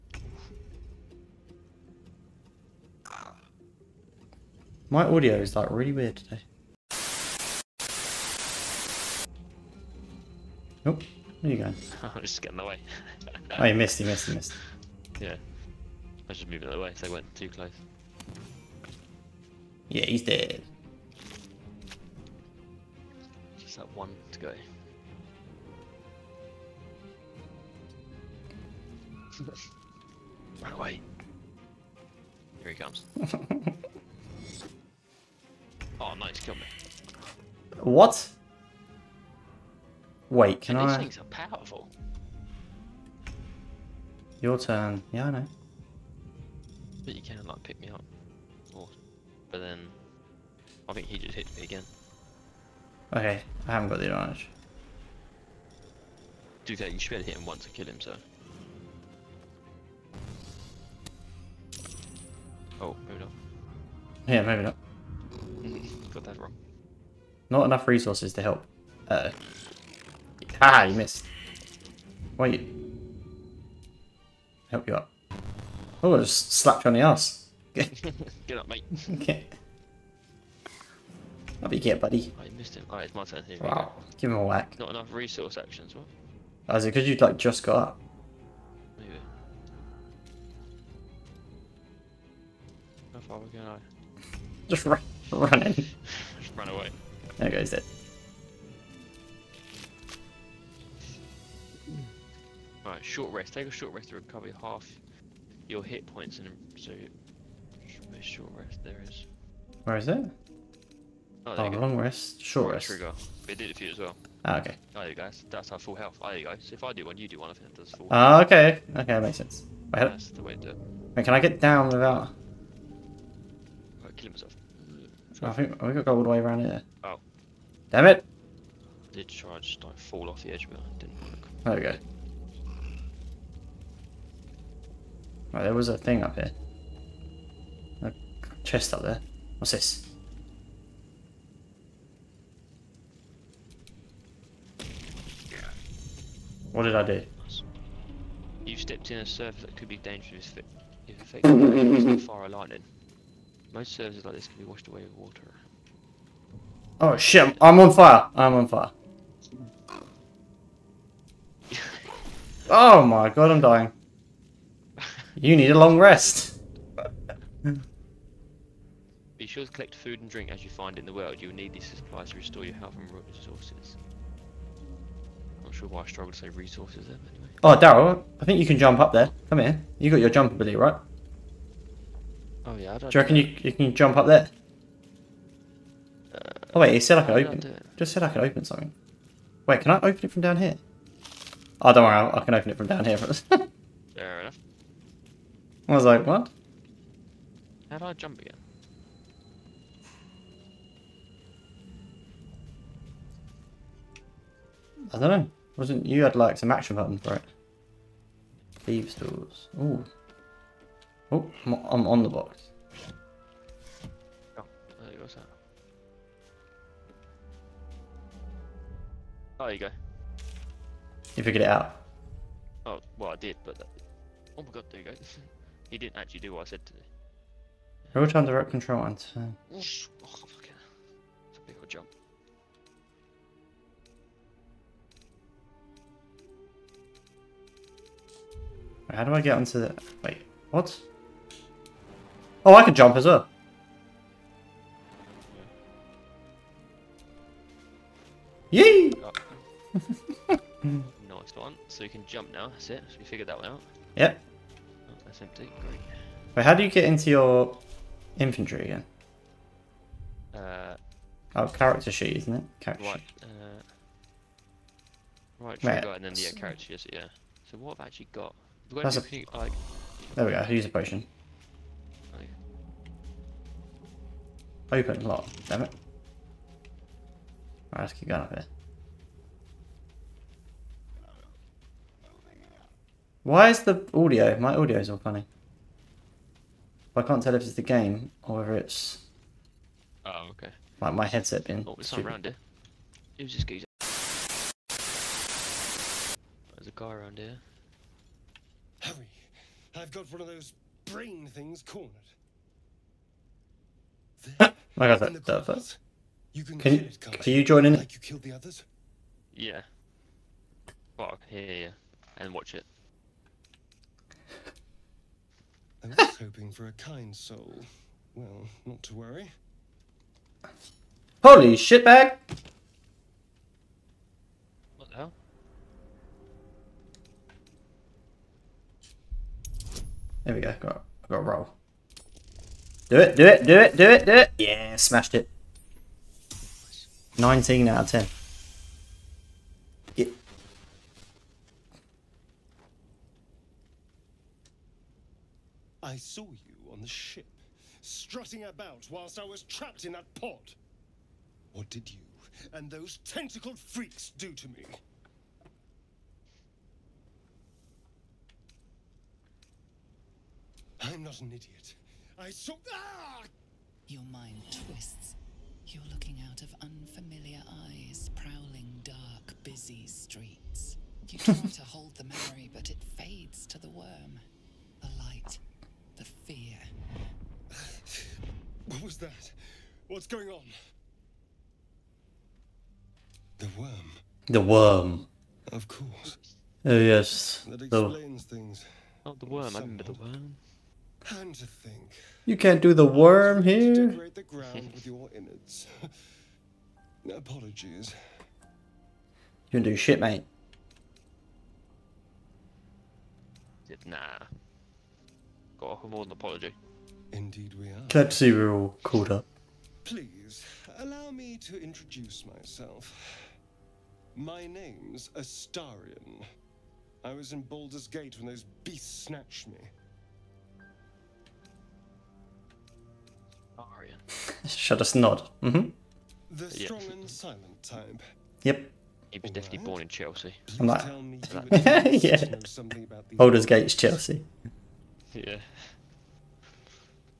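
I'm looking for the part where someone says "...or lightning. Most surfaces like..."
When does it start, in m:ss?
2:32.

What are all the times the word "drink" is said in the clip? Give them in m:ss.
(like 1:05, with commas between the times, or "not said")
2:50.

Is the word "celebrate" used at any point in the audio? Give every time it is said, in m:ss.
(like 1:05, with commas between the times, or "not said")
not said.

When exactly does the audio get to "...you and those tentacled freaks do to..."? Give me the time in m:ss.
5:52.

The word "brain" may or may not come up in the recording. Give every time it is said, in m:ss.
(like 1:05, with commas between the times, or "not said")
5:01.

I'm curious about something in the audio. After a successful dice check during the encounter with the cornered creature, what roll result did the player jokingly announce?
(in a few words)
19 out of 10.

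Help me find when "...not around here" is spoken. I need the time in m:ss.
4:52.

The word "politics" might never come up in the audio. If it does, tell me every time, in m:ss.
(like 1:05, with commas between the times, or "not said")
not said.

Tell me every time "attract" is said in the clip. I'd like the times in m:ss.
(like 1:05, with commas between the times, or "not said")
not said.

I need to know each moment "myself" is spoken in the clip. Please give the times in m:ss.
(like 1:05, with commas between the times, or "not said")
2:04, 6:52.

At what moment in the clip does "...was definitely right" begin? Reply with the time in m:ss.
7:09.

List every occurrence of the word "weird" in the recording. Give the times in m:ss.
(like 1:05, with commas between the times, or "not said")
0:05.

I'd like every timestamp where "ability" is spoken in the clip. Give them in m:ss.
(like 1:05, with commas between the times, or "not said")
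3:00.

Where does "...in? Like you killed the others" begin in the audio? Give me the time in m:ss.
5:07.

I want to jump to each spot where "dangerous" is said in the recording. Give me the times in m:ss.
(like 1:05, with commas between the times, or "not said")
2:29.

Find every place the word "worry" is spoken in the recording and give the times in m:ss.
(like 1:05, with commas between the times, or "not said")
3:12, 5:19.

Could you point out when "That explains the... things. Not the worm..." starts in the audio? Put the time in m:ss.
6:27.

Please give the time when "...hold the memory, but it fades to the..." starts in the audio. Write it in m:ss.
6:11.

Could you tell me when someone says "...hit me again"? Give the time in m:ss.
0:51.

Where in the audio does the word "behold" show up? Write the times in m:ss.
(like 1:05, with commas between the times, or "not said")
not said.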